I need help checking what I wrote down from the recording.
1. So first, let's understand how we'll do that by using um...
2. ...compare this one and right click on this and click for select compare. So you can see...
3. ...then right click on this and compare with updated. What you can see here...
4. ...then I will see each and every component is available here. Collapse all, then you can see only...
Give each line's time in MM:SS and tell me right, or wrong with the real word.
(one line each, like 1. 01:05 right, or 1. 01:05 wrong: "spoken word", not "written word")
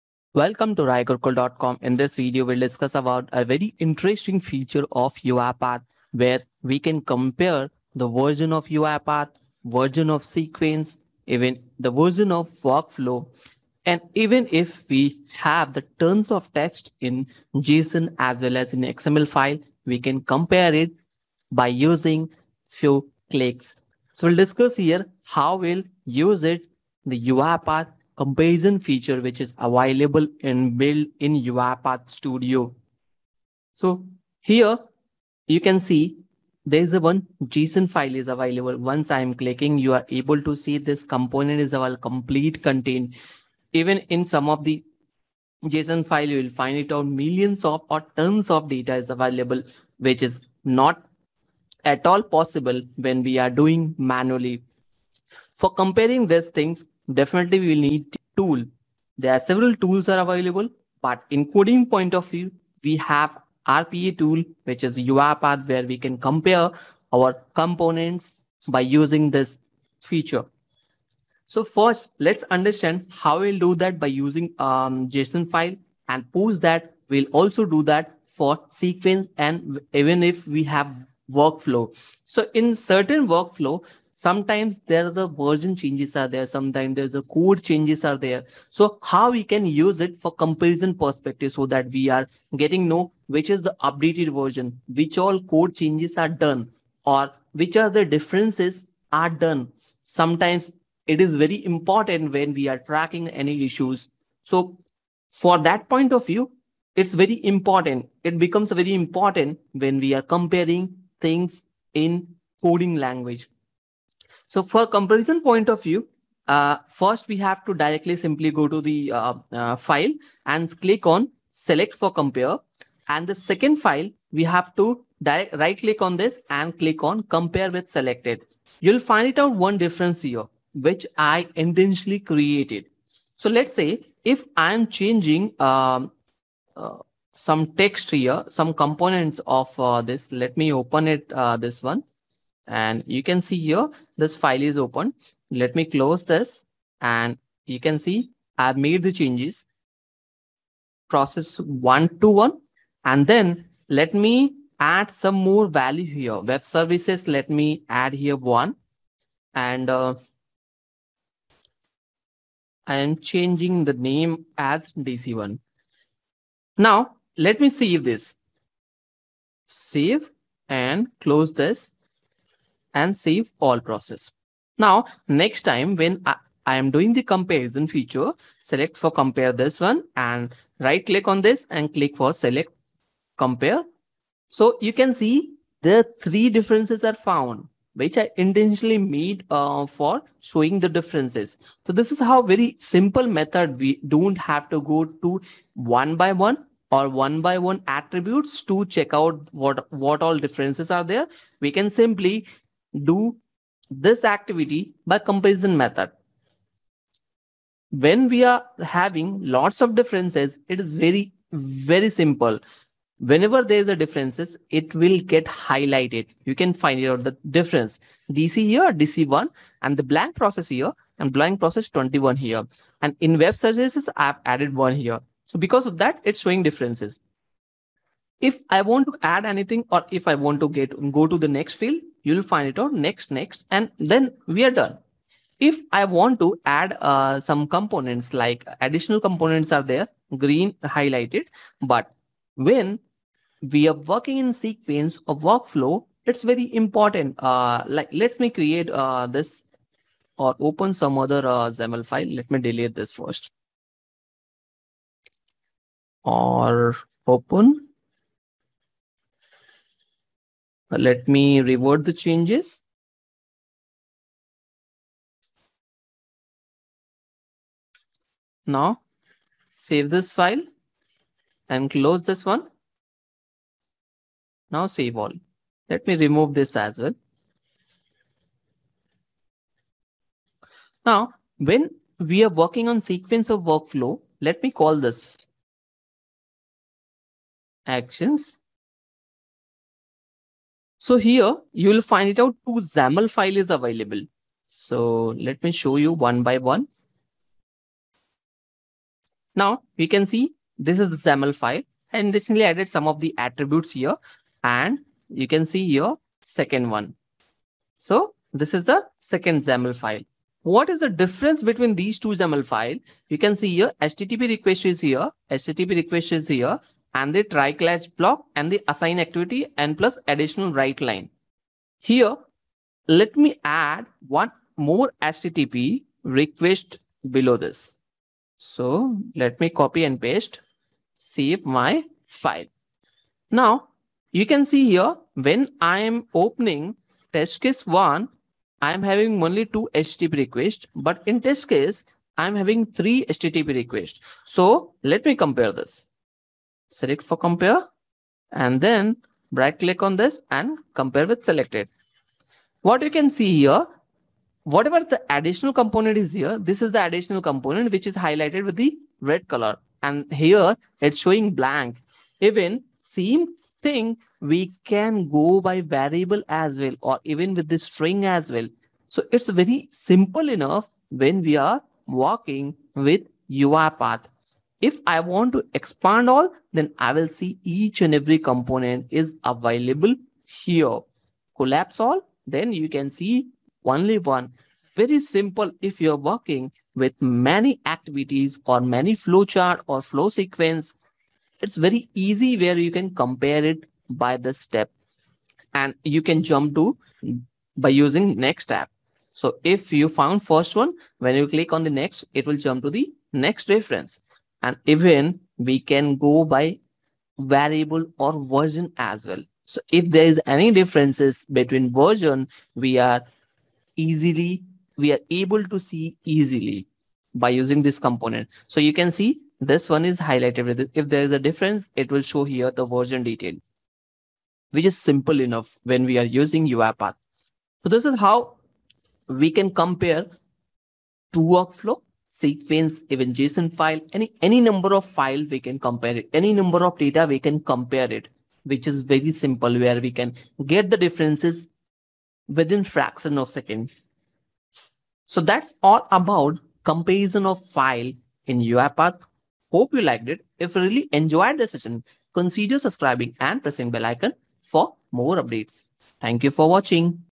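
1. 01:11 right
2. 02:59 right
3. 05:48 wrong: "selected", not "updated"
4. 06:16 right.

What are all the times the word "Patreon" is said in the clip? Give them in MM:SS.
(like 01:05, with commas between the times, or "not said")
not said.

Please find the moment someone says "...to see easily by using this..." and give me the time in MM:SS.
06:55.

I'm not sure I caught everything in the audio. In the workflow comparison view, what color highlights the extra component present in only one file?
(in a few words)
Red.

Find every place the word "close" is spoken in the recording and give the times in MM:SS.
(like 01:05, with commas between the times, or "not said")
02:25, 02:51, 04:31.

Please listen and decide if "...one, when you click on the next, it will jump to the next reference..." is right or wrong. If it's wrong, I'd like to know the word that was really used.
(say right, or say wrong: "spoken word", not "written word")
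right.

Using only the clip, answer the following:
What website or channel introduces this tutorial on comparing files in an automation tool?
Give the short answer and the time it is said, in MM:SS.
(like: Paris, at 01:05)
RaiGurukul.com, at 00:00.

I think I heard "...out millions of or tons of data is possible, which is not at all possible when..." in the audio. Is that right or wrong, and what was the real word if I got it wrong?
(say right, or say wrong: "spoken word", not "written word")
wrong: "available", not "possible".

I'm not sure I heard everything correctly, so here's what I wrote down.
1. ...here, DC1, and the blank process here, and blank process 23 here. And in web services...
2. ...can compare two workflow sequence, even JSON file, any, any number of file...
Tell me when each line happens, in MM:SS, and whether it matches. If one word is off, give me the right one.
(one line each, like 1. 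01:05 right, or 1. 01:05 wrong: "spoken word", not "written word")
1. 03:38 wrong: "21", not "23"
2. 07:09 right.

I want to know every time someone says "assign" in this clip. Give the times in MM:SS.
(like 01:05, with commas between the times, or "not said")
05:18.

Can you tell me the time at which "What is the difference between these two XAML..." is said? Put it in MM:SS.
05:10.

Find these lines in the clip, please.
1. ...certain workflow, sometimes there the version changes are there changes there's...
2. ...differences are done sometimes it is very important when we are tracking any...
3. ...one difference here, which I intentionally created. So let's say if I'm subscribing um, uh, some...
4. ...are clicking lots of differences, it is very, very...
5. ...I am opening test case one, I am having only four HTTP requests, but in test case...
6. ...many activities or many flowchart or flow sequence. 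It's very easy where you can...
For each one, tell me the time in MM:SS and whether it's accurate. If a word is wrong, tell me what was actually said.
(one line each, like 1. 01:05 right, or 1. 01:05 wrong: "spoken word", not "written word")
1. 01:22 wrong: "sometimes", not "changes"
2. 01:38 right
3. 02:09 wrong: "changing", not "subscribing"
4. 03:28 wrong: "having", not "clicking"
5. 05:35 wrong: "two", not "four"
6. 06:27 right.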